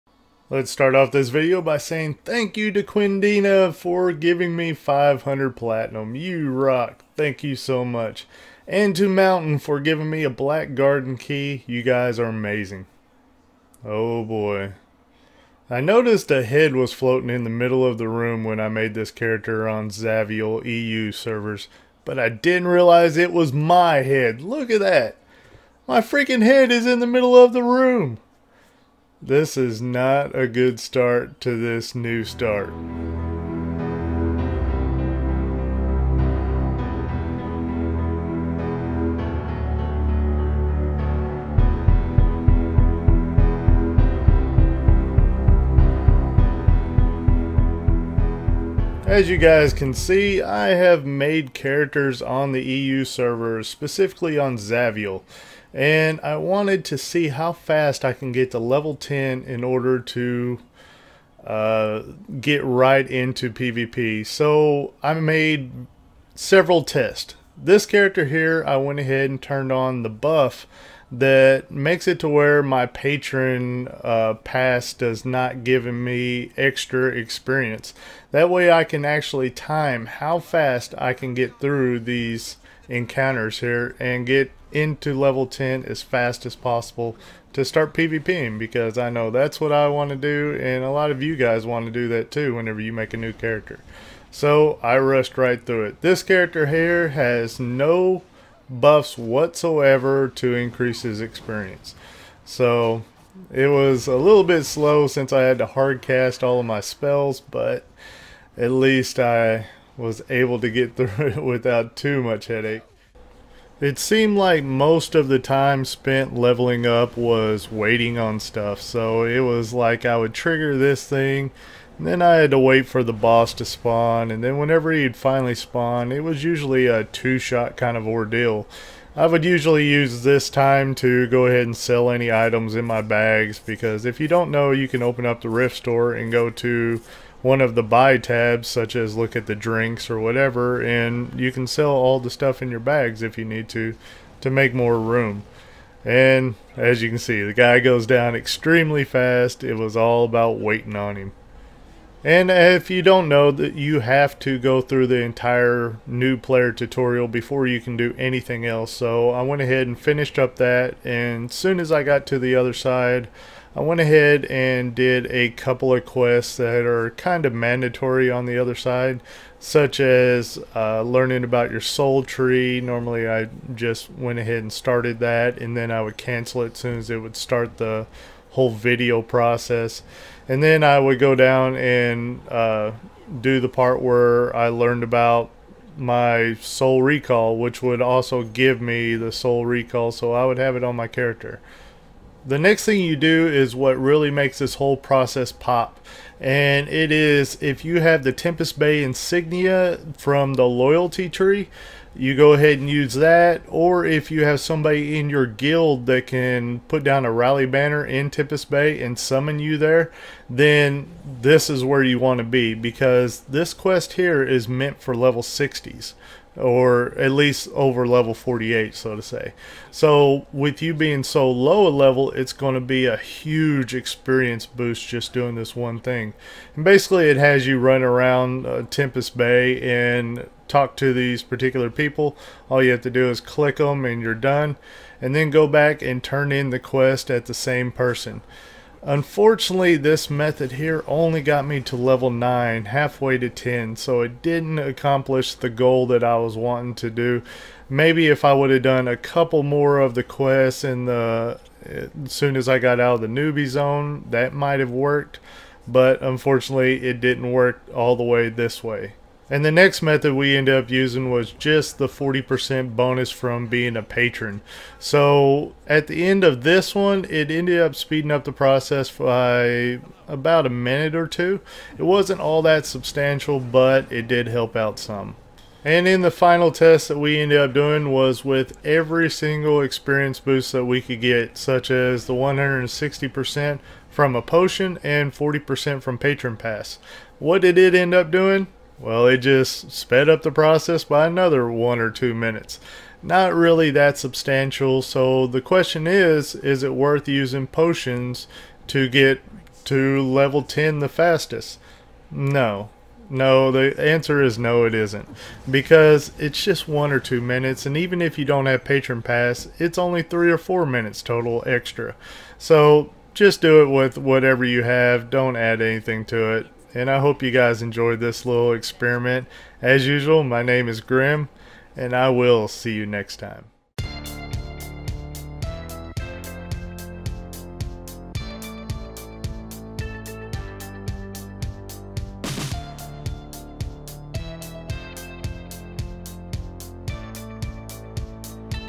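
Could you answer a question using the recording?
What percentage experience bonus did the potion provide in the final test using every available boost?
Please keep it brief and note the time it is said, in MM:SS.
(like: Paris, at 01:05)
160%, at 04:42.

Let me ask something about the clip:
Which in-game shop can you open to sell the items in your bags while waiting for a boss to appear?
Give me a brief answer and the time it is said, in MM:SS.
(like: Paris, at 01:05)
Rift Store, at 02:15.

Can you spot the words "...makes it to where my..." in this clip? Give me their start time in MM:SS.
01:11.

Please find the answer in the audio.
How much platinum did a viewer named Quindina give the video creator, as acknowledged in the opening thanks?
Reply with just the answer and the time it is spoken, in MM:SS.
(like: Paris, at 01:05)
500, at 00:04.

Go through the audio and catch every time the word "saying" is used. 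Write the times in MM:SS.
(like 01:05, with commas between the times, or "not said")
00:01.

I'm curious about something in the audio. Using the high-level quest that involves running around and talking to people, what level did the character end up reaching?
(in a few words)
level 9.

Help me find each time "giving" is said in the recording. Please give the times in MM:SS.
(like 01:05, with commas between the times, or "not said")
00:04, 00:09.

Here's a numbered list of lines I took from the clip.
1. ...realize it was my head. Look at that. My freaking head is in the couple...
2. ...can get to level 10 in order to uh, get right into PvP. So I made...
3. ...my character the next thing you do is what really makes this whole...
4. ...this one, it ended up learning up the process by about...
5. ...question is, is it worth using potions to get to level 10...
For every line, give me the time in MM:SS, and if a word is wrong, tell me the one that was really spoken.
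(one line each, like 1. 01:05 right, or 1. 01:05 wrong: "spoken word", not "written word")
1. 00:22 wrong: "middle", not "couple"
2. 00:58 right
3. 03:10 right
4. 04:26 wrong: "speeding", not "learning"
5. 04:55 right.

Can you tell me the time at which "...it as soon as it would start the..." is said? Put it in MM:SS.
02:56.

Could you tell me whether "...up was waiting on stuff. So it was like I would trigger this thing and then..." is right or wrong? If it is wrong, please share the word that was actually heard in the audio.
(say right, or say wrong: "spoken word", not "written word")
right.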